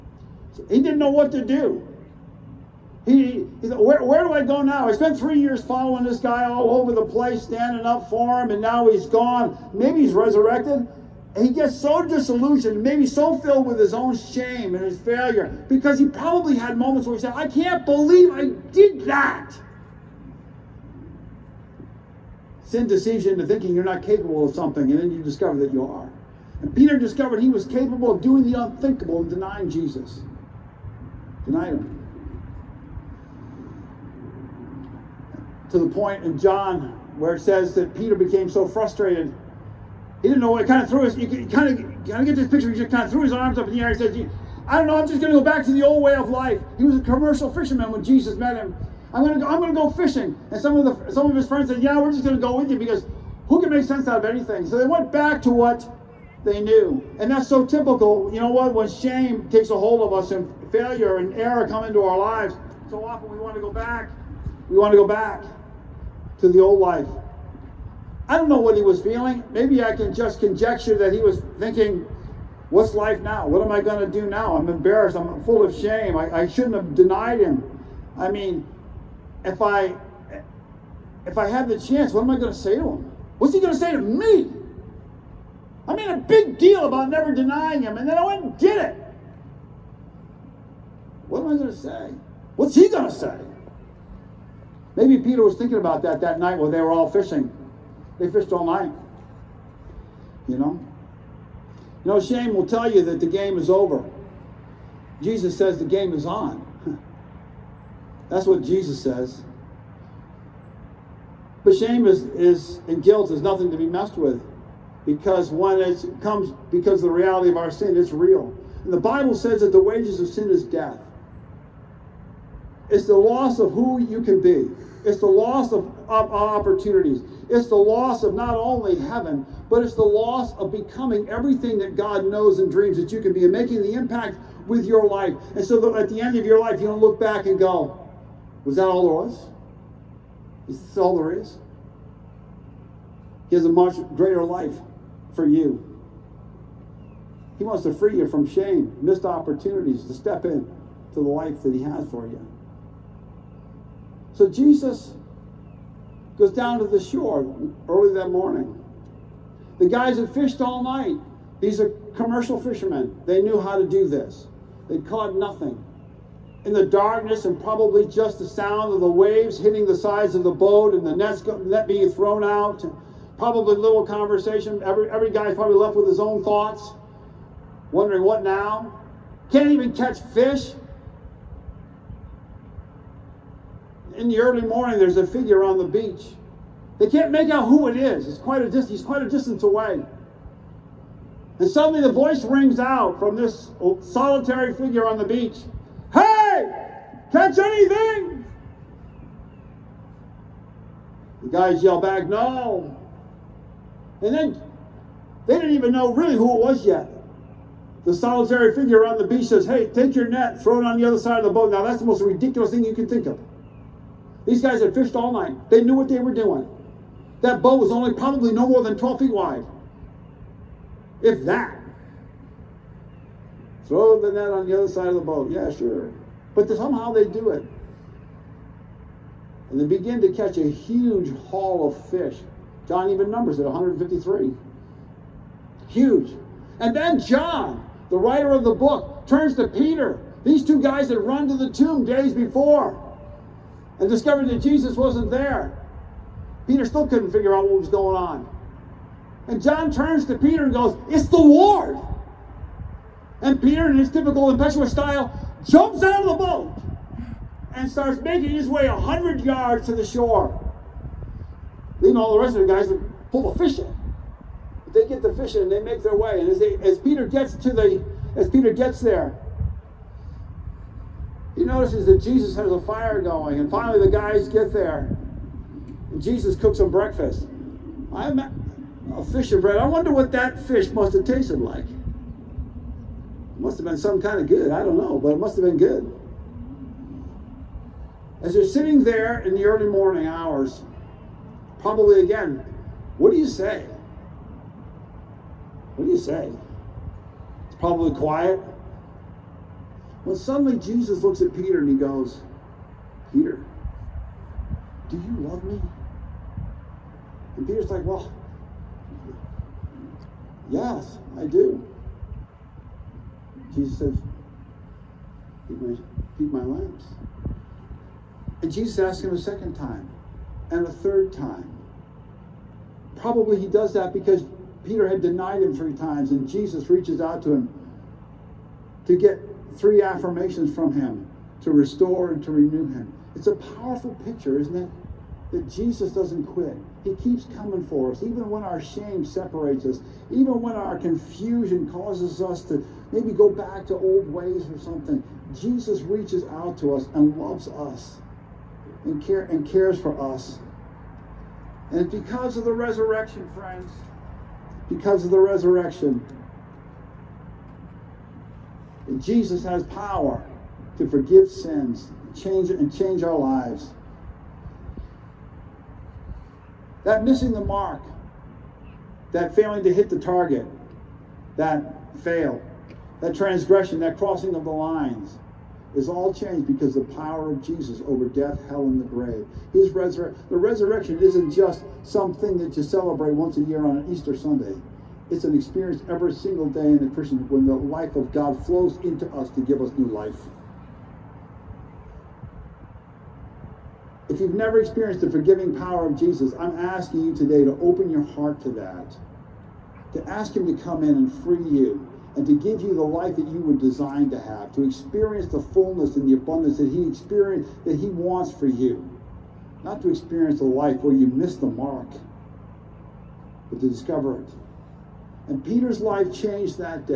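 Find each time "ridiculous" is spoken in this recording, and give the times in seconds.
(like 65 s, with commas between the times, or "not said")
212 s.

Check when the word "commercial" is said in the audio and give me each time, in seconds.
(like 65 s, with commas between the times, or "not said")
46 s, 162 s.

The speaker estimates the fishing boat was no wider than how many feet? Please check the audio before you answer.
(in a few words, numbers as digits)
12.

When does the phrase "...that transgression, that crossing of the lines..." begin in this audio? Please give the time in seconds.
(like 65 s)
373 s.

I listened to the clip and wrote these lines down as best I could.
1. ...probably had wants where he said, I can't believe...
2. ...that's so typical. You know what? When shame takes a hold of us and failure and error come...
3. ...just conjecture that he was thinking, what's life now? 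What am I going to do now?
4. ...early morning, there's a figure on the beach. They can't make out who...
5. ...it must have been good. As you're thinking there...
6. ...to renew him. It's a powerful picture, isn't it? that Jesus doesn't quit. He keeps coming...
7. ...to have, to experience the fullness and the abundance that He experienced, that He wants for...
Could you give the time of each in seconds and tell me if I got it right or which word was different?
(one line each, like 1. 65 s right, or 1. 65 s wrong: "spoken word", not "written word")
1. 16 s wrong: "moments", not "wants"
2. 57 s right
3. 70 s right
4. 184 s right
5. 285 s wrong: "sitting", not "thinking"
6. 332 s right
7. 404 s right.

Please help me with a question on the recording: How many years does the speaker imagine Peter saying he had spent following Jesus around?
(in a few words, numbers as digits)
3.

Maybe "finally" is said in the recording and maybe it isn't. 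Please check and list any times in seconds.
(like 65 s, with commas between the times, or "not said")
273 s.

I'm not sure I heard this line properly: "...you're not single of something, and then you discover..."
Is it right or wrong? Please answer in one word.
wrong.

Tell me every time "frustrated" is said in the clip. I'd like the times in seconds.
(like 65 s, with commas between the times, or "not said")
38 s.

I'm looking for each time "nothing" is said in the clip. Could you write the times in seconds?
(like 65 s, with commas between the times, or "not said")
113 s, 165 s.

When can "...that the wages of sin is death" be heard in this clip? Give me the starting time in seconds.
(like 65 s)
119 s.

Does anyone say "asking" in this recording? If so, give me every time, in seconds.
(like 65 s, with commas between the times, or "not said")
396 s.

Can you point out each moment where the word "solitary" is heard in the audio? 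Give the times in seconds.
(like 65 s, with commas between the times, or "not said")
194 s, 208 s.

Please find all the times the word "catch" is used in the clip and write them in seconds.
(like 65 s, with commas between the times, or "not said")
179 s, 197 s, 230 s.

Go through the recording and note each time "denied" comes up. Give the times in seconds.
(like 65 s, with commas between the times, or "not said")
31 s, 76 s, 325 s.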